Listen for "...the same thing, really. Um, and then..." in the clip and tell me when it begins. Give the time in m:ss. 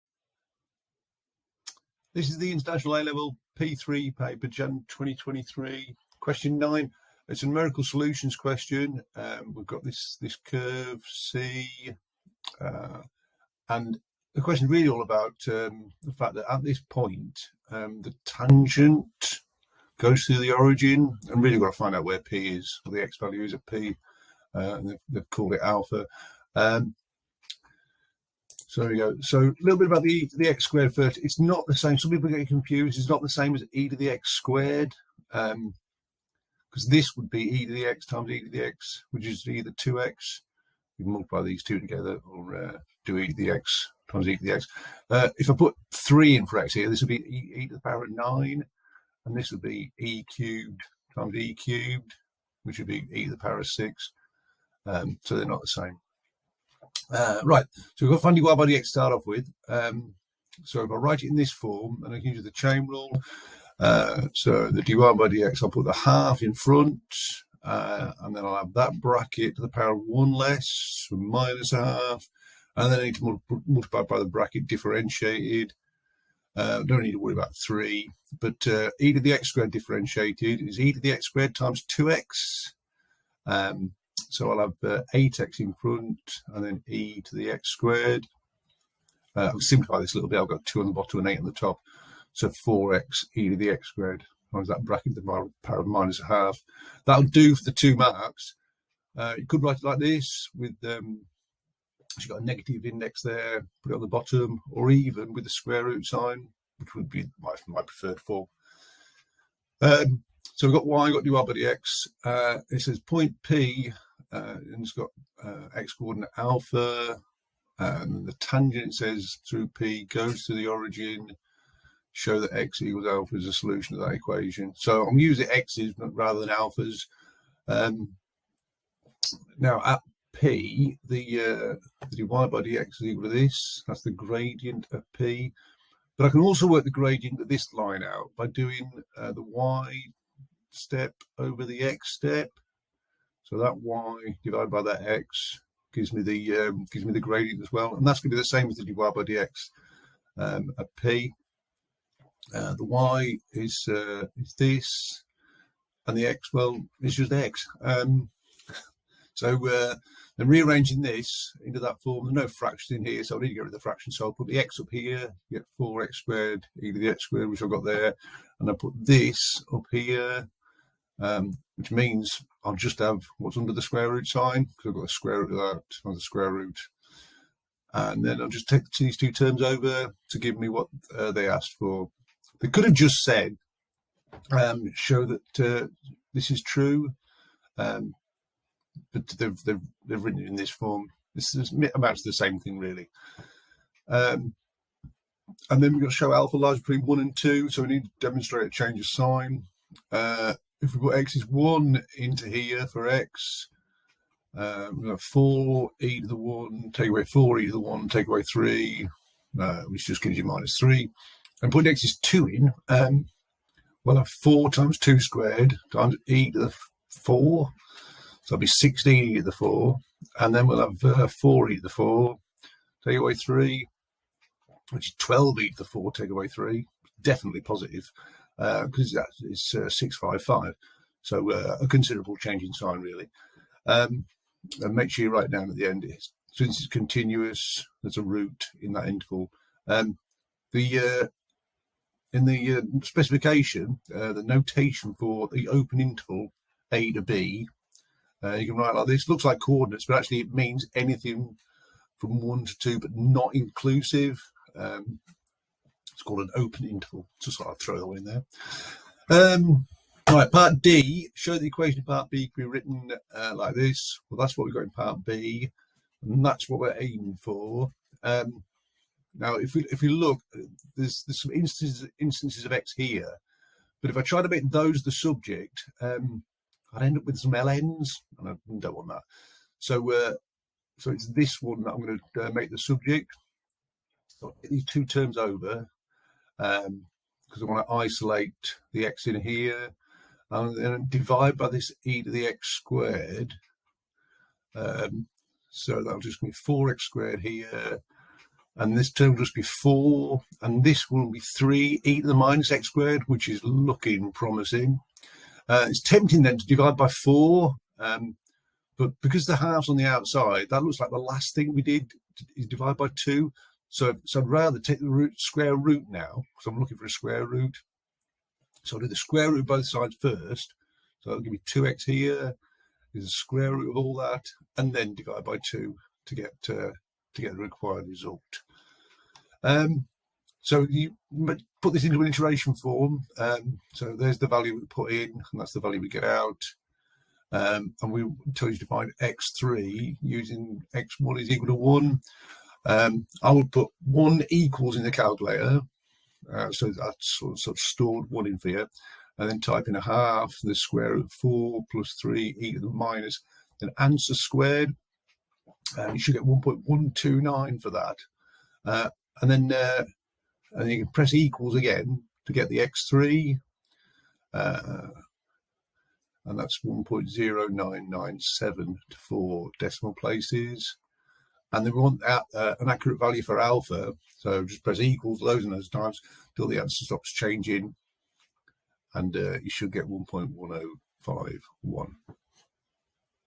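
3:12.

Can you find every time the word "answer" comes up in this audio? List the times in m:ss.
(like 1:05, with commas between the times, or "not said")
5:53, 6:16.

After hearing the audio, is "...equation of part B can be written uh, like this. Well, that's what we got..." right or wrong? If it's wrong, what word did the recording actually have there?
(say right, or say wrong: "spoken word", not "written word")
right.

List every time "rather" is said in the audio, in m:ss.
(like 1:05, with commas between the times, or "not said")
2:06, 5:14.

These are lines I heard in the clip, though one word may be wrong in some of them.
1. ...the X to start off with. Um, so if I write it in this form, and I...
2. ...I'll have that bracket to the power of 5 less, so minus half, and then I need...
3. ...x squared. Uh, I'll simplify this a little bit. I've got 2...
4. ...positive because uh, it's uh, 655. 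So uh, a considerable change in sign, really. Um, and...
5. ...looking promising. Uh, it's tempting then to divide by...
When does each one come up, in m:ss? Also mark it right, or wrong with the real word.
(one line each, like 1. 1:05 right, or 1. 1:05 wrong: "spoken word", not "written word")
1. 0:58 right
2. 1:08 wrong: "1", not "5"
3. 1:27 right
4. 3:47 right
5. 5:03 right.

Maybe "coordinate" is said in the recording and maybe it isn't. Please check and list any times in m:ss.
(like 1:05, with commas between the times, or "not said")
1:55, 4:09.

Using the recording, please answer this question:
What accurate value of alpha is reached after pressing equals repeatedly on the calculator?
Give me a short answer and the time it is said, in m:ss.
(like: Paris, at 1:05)
1.1051, at 6:20.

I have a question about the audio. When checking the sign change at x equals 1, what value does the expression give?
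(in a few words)
-3.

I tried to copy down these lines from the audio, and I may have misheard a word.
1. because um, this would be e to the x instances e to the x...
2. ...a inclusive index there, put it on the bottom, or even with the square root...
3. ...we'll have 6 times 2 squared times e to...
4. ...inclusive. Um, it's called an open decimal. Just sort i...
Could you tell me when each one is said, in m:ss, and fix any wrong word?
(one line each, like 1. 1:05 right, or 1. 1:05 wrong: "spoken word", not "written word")
1. 0:35 wrong: "times", not "instances"
2. 1:42 wrong: "negative", not "inclusive"
3. 3:34 wrong: "4", not "6"
4. 4:13 wrong: "interval", not "decimal".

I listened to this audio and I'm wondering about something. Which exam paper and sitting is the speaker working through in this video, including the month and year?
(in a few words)
Jan 2023.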